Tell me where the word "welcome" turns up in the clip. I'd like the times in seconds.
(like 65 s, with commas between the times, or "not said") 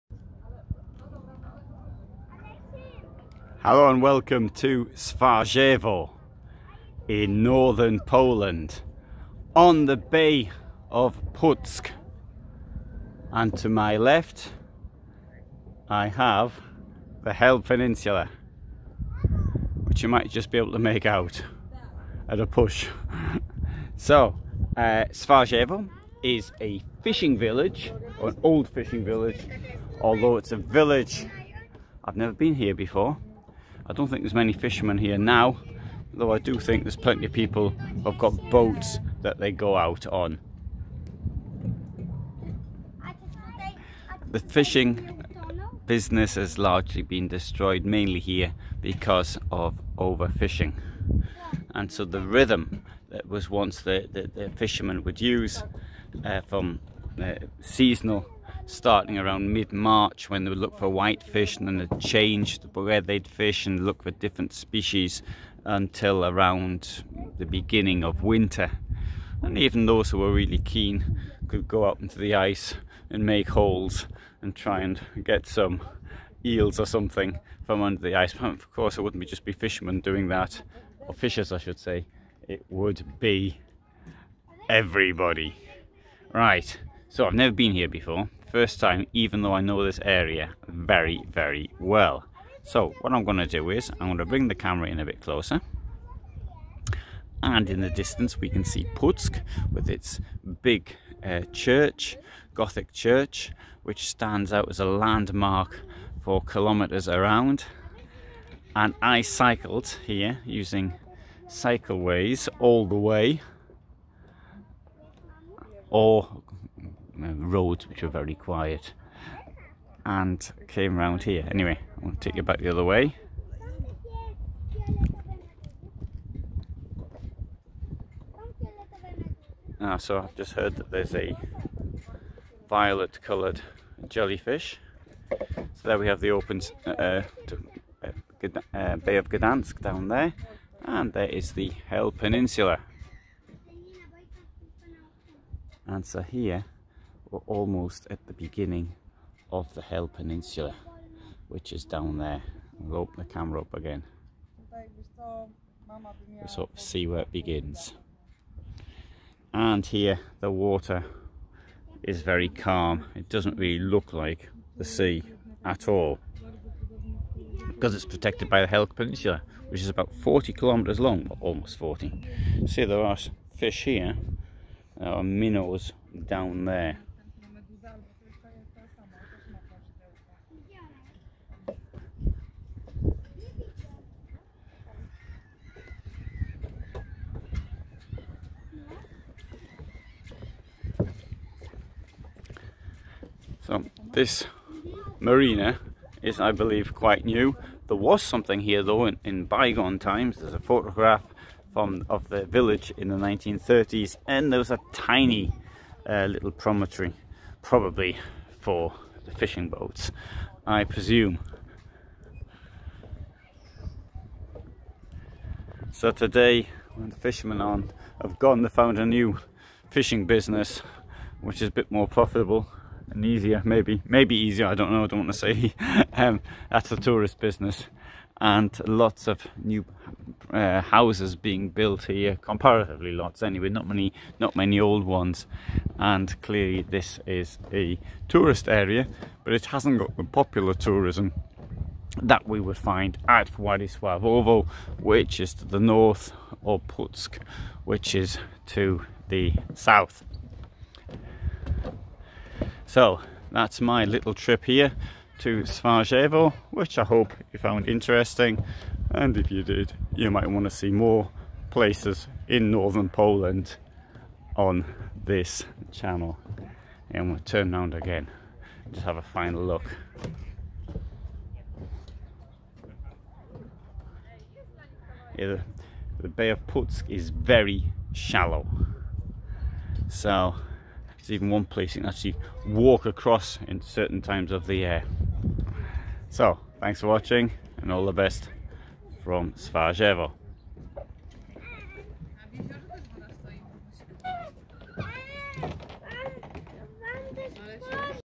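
4 s.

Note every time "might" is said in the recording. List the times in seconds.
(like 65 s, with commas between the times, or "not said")
20 s, 260 s.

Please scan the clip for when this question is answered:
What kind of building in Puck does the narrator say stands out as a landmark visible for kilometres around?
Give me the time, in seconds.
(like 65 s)
102 s.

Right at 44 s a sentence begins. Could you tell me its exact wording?
The fishing business has largely been destroyed, mainly here because of overfishing.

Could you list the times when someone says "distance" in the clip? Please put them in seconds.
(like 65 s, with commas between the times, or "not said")
97 s.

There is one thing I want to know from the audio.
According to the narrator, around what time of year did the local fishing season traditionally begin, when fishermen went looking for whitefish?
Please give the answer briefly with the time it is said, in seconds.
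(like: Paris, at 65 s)
mid-March, at 59 s.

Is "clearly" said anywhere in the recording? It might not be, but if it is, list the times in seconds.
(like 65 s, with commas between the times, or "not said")
236 s.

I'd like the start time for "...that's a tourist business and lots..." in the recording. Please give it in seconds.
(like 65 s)
226 s.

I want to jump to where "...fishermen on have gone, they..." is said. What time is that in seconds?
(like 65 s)
217 s.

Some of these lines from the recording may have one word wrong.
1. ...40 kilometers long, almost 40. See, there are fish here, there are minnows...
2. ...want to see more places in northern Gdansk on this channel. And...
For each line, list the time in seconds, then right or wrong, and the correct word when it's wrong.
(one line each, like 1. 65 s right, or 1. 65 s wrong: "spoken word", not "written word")
1. 170 s right
2. 260 s wrong: "Poland", not "Gdansk".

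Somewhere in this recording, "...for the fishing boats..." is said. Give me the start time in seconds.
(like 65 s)
208 s.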